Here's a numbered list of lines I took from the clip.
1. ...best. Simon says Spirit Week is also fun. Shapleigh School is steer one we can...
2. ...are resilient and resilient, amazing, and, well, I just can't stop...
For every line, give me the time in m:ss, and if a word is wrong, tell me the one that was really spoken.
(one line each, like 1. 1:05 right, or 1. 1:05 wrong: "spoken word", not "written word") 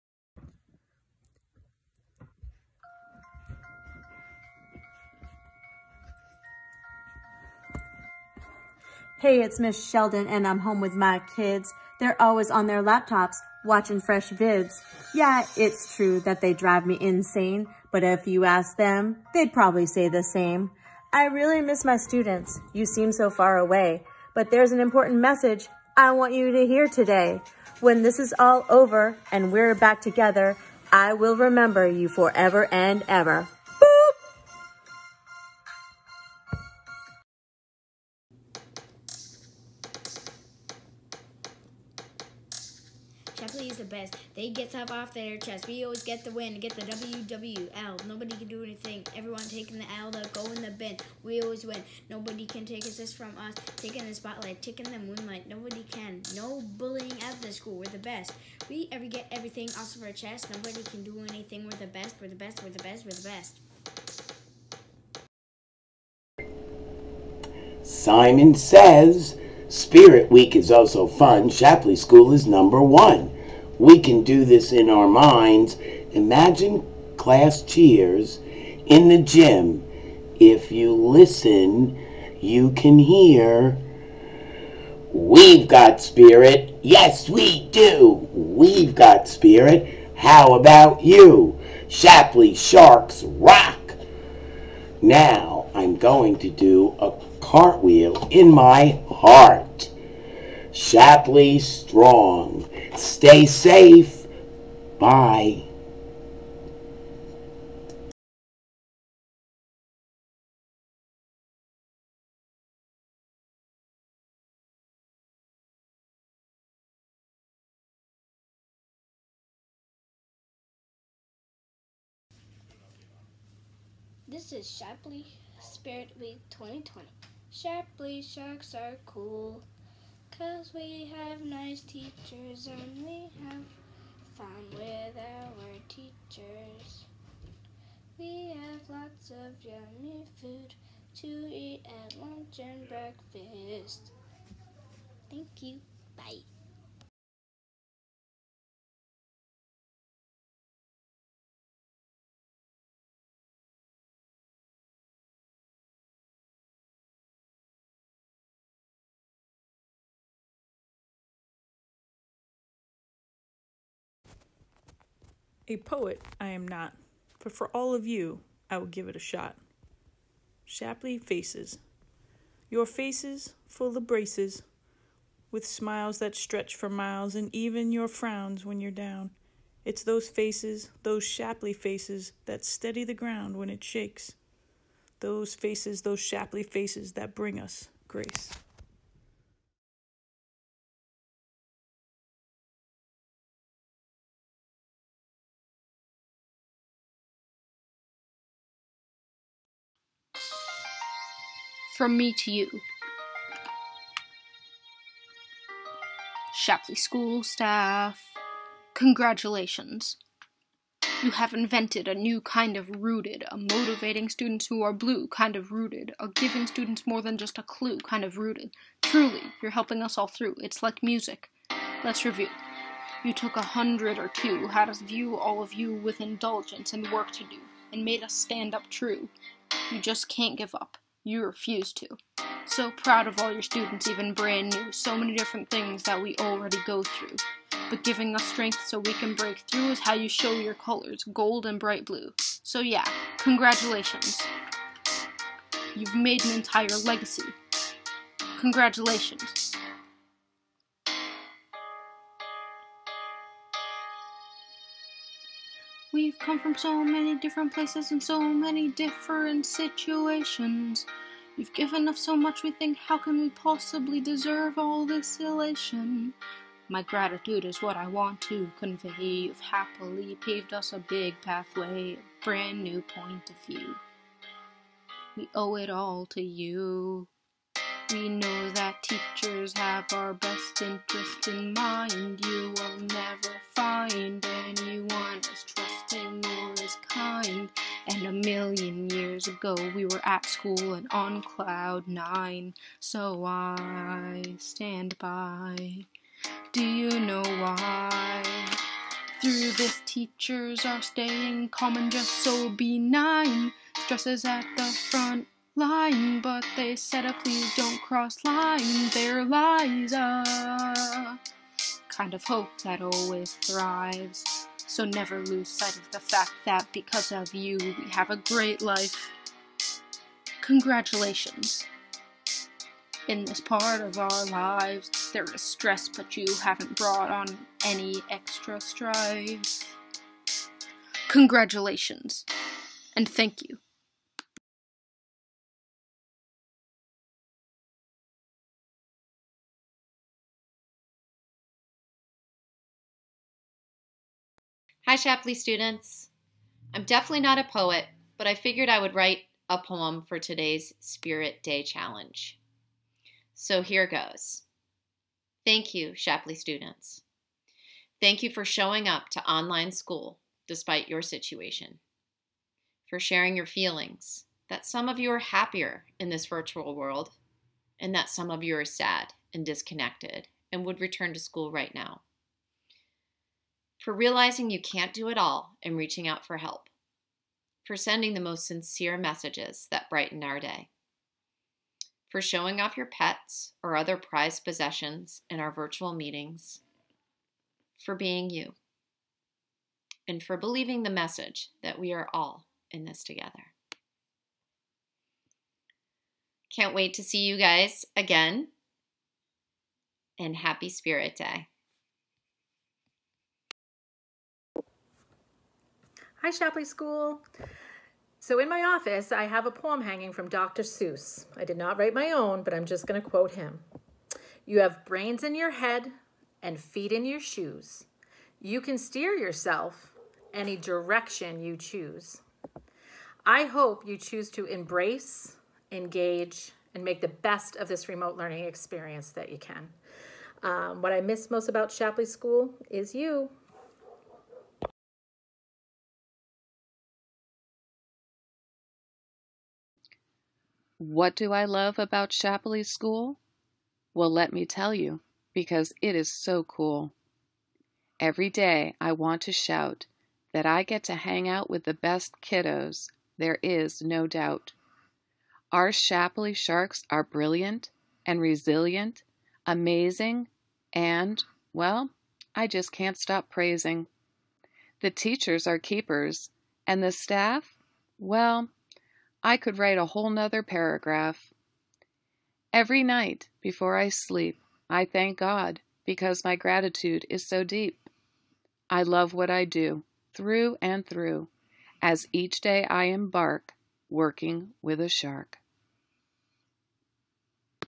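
1. 1:07 wrong: "number", not "steer"
2. 7:37 wrong: "brilliant", not "resilient".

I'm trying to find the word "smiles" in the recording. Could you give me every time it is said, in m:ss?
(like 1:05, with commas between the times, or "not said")
2:55.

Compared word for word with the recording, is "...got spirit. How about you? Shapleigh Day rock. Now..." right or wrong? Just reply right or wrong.
wrong.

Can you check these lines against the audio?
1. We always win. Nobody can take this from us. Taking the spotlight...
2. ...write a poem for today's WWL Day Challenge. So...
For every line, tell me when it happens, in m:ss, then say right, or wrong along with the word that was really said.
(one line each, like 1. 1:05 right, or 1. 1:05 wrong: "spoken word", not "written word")
1. 0:51 right
2. 5:49 wrong: "Spirit", not "WWL".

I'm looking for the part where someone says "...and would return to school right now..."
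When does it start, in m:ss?
6:10.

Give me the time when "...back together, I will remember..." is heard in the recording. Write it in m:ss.
0:29.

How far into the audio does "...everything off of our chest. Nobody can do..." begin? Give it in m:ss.
0:59.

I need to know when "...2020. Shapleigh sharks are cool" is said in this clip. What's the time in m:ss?
2:06.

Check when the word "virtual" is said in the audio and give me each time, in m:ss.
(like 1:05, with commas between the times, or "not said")
6:06, 6:25.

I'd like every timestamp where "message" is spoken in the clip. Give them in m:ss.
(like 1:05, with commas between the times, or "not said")
0:25, 6:19, 6:31.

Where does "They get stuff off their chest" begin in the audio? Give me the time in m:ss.
0:44.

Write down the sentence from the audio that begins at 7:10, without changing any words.
Um, what I miss most about Shapleigh School is you.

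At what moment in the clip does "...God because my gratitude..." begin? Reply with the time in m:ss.
7:55.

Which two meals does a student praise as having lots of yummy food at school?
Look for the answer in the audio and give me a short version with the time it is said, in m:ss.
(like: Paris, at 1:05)
lunch and breakfast, at 2:22.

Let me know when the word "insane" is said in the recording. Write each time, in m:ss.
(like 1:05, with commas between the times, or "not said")
0:16.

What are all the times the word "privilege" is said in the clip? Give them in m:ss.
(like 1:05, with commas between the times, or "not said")
not said.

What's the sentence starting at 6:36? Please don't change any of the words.
Can't wait to see you guys again, and happy Spirit Day.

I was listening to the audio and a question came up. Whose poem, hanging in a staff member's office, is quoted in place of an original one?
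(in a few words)
Dr. Seuss.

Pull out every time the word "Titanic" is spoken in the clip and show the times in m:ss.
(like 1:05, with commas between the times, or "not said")
not said.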